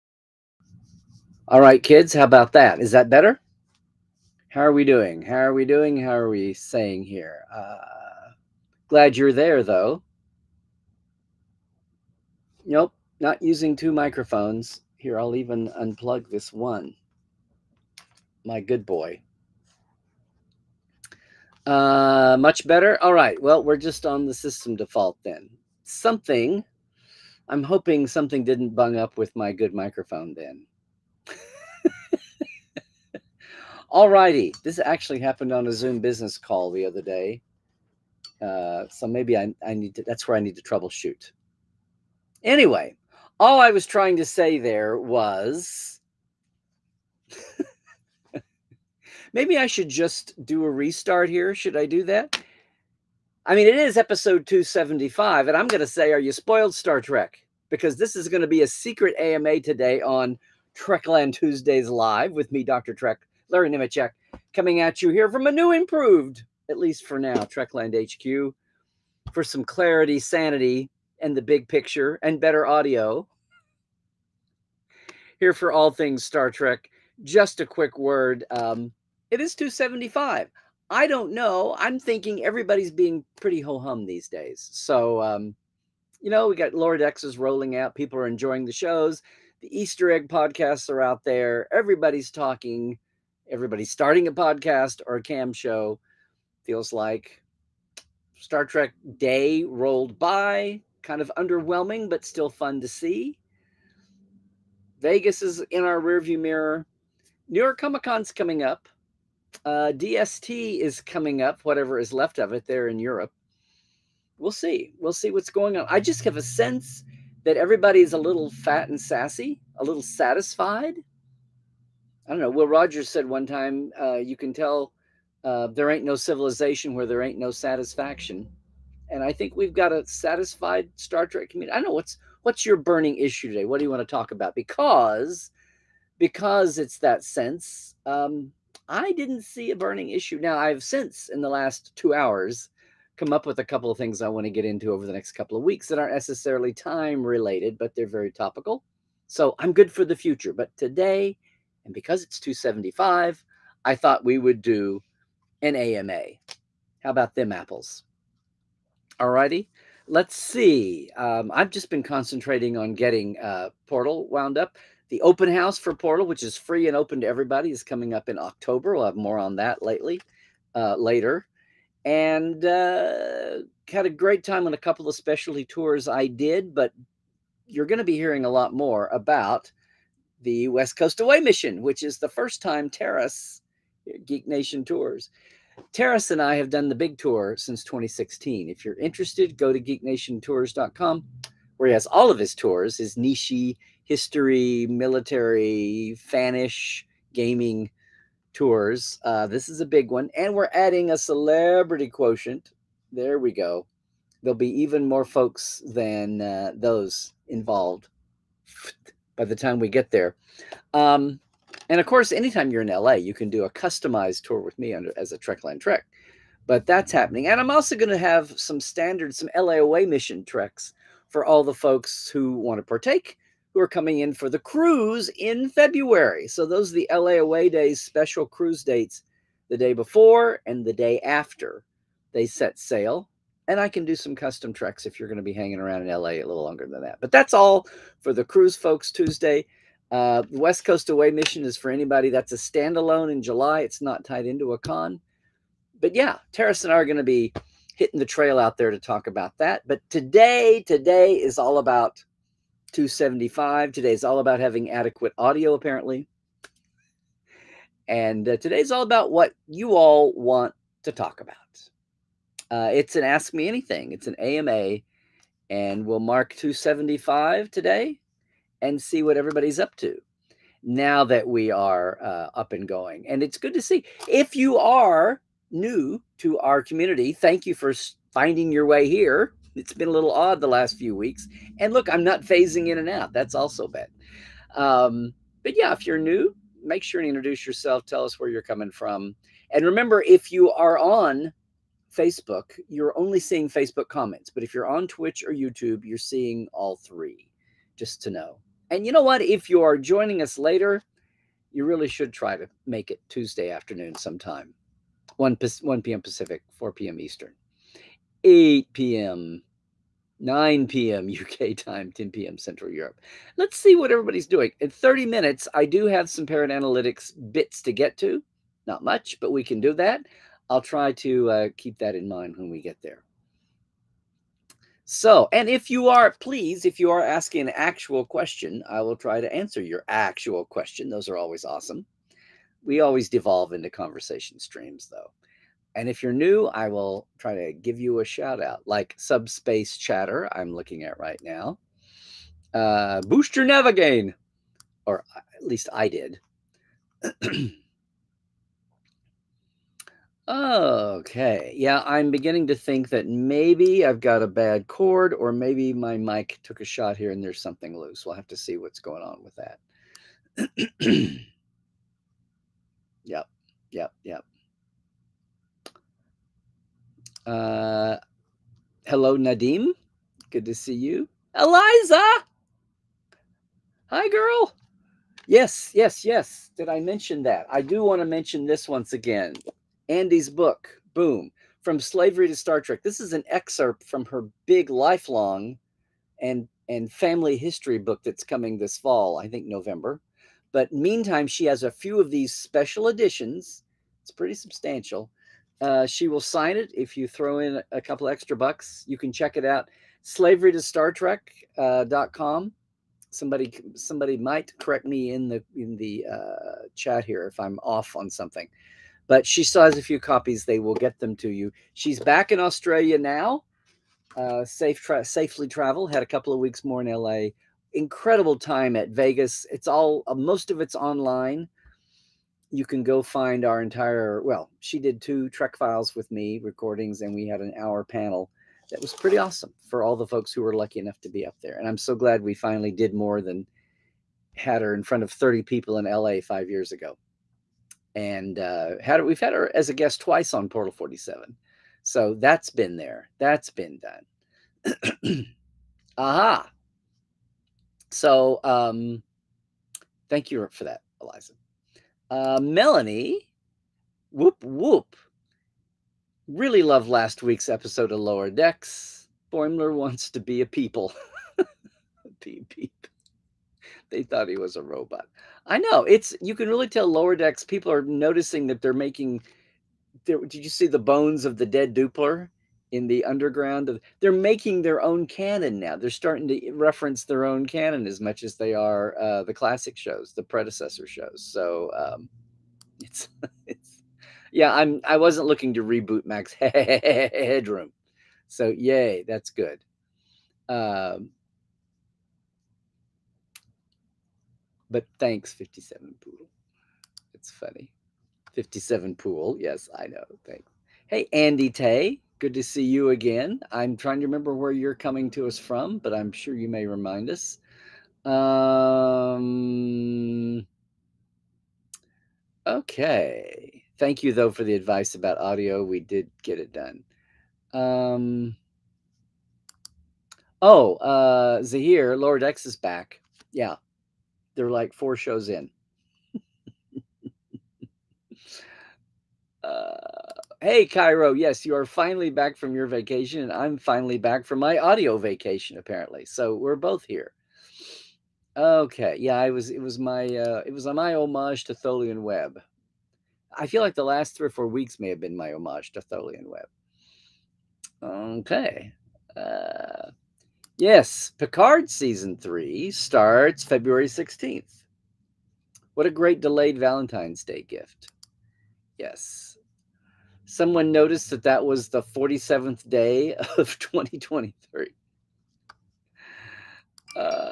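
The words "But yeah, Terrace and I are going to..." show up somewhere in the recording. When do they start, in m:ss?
4:05.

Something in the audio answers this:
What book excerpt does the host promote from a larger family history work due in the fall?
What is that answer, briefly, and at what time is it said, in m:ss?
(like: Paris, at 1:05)
From Slavery to Star Trek, at 6:21.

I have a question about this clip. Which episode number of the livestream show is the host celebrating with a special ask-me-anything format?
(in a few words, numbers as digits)
275.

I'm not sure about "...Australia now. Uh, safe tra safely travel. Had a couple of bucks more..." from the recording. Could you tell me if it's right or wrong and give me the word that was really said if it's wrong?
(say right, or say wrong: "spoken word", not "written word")
wrong: "weeks", not "bucks".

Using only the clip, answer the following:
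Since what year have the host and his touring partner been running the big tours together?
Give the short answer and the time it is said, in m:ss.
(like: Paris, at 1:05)
2016, at 3:07.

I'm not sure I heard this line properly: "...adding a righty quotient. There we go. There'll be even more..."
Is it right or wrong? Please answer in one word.
wrong.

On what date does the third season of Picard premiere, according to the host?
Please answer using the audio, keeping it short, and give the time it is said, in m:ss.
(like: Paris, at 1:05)
February 16th, at 9:13.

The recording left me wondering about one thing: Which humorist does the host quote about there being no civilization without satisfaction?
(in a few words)
Will Rogers.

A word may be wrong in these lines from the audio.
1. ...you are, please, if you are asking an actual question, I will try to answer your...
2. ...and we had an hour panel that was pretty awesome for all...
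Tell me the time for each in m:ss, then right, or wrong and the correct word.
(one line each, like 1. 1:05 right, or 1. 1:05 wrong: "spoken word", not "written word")
1. 5:25 right
2. 7:07 right.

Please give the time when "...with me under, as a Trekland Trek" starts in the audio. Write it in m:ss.
3:34.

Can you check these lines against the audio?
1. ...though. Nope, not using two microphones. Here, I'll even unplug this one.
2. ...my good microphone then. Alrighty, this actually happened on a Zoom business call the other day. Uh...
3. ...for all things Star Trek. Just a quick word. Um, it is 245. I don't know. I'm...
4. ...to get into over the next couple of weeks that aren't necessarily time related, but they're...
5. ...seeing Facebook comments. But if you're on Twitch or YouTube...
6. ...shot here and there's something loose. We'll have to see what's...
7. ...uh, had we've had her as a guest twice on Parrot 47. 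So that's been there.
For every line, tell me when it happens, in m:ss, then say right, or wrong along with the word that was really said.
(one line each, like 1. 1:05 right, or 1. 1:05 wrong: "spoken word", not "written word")
1. 0:09 right
2. 0:29 right
3. 1:15 wrong: "275", not "245"
4. 2:24 right
5. 4:53 right
6. 5:56 right
7. 7:18 wrong: "Portal", not "Parrot".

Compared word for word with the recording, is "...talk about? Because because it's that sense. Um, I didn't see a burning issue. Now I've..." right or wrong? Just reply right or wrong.
right.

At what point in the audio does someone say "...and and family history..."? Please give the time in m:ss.
6:26.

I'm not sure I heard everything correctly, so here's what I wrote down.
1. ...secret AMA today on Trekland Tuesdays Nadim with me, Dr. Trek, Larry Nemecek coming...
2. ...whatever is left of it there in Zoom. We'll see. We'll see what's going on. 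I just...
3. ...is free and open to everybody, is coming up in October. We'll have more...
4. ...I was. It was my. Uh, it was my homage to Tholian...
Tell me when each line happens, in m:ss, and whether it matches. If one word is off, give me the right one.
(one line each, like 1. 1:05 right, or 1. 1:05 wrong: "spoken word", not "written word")
1. 0:58 wrong: "Live", not "Nadim"
2. 1:51 wrong: "Europe", not "Zoom"
3. 2:46 right
4. 8:59 right.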